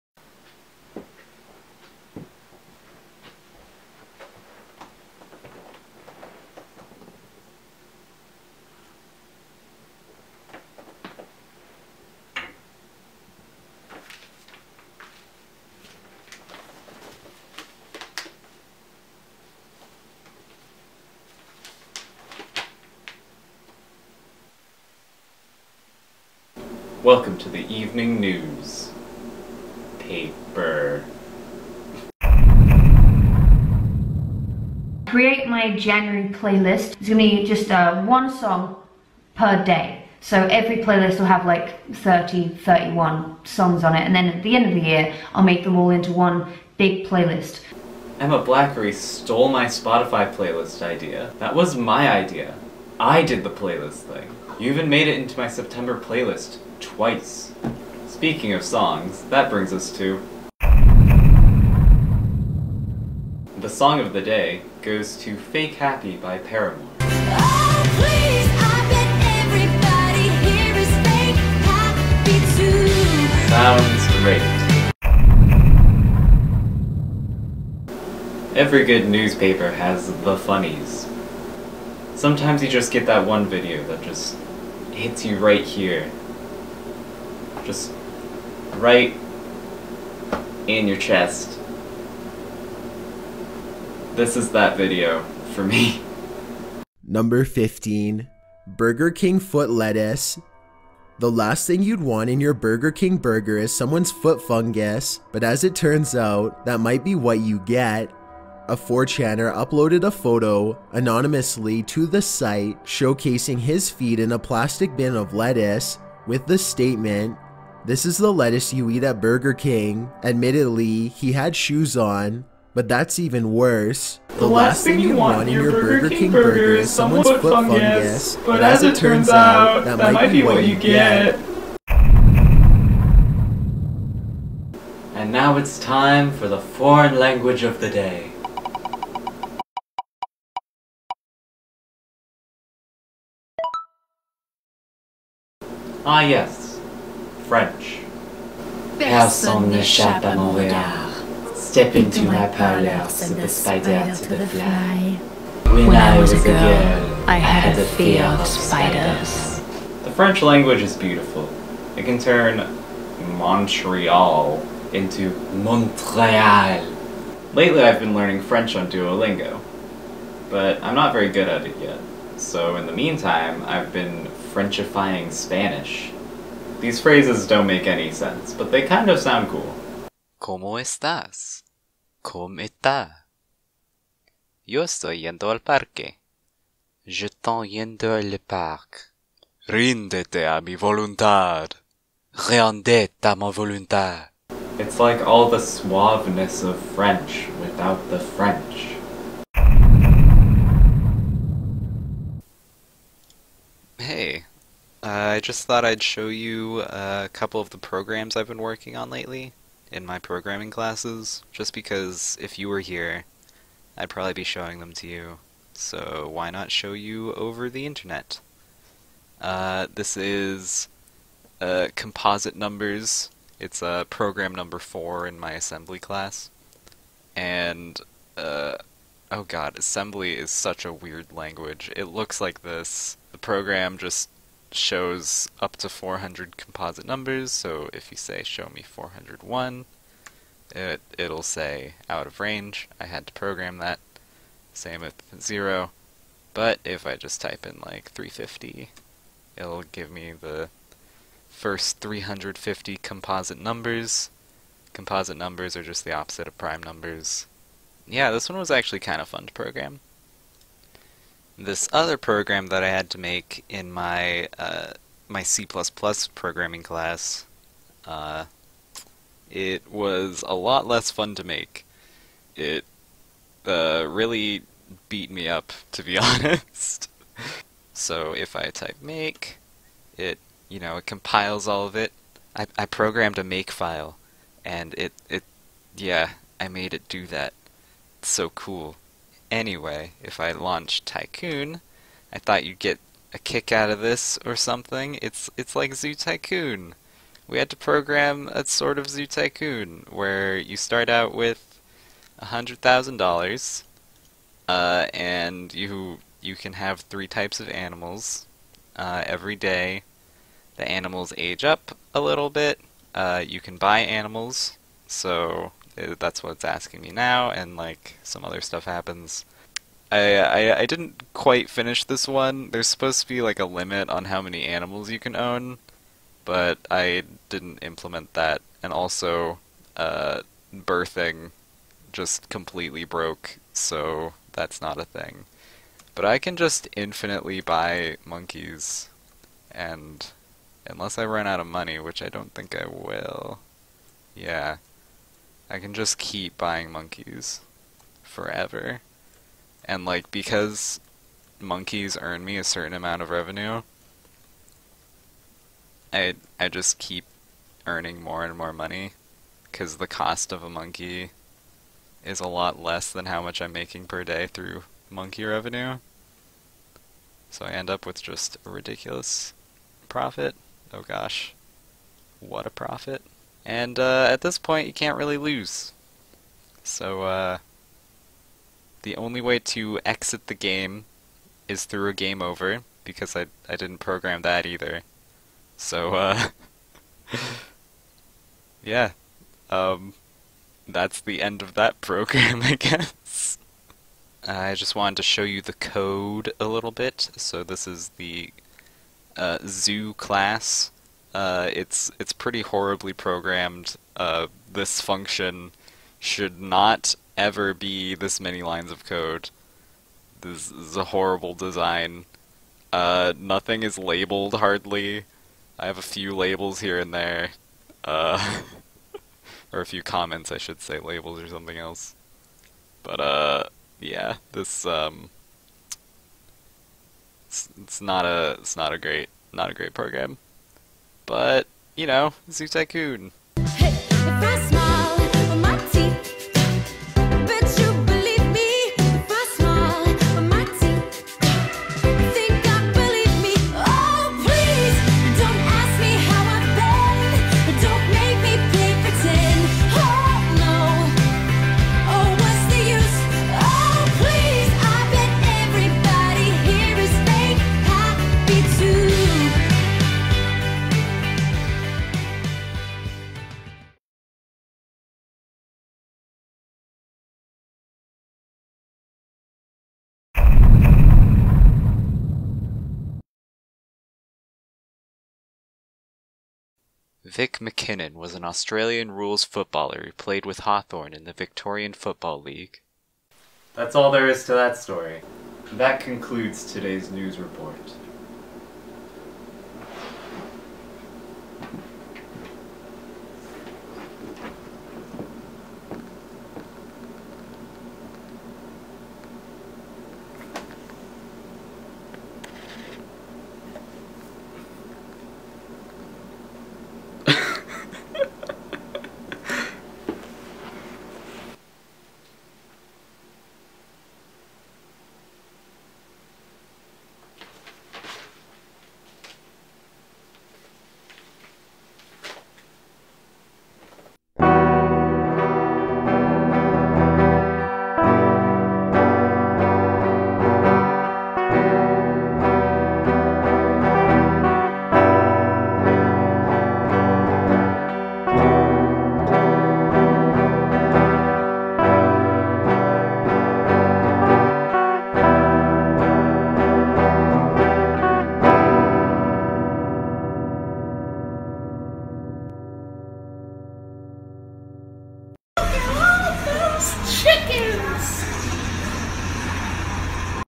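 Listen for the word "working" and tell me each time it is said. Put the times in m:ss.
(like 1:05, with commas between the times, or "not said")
3:28.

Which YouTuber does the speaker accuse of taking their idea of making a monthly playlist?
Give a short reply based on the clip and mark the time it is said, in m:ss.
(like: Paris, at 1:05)
Emma Blackery, at 0:48.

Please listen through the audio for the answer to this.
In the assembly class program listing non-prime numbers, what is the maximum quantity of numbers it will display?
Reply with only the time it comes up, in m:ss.
3:55.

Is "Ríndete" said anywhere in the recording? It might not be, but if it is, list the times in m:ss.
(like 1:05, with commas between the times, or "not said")
3:09.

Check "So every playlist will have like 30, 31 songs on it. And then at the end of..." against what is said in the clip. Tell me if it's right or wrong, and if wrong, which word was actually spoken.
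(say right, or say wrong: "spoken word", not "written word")
right.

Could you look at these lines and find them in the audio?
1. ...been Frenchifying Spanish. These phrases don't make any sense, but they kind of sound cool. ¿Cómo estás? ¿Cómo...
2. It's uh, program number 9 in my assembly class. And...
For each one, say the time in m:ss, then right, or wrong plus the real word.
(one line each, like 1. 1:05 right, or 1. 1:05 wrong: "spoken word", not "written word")
1. 2:53 right
2. 3:43 wrong: "4", not "9".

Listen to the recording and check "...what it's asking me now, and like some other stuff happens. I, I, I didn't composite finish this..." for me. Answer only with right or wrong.
wrong.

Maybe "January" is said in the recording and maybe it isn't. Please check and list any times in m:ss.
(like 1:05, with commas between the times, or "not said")
0:35.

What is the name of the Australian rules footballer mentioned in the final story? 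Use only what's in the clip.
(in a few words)
Vic McKinnon.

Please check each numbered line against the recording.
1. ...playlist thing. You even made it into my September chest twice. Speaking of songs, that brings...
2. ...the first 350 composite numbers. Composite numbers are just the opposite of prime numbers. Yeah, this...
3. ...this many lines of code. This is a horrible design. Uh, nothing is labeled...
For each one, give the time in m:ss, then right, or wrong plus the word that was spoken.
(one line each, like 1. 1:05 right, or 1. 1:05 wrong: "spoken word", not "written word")
1. 0:53 wrong: "playlist", not "chest"
2. 4:10 right
3. 6:48 right.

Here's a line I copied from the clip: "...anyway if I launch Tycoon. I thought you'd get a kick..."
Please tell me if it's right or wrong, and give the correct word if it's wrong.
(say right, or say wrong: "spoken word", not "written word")
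right.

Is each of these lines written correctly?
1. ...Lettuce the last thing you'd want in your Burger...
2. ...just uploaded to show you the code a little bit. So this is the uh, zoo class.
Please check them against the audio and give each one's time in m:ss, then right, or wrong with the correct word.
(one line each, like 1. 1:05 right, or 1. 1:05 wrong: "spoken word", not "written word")
1. 1:39 right
2. 6:34 wrong: "wanted", not "uploaded".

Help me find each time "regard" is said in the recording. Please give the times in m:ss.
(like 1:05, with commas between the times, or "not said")
2:30.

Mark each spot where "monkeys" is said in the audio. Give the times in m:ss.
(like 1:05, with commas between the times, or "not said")
5:38, 5:46, 5:51, 6:00, 6:05.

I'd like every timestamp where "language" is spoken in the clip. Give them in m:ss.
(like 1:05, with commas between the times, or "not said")
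2:17, 2:40, 3:51.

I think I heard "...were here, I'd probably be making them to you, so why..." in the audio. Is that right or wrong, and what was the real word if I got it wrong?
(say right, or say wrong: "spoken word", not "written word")
wrong: "showing", not "making".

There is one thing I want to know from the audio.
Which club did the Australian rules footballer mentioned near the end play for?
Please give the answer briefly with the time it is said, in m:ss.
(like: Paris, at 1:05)
Hawthorn, at 8:00.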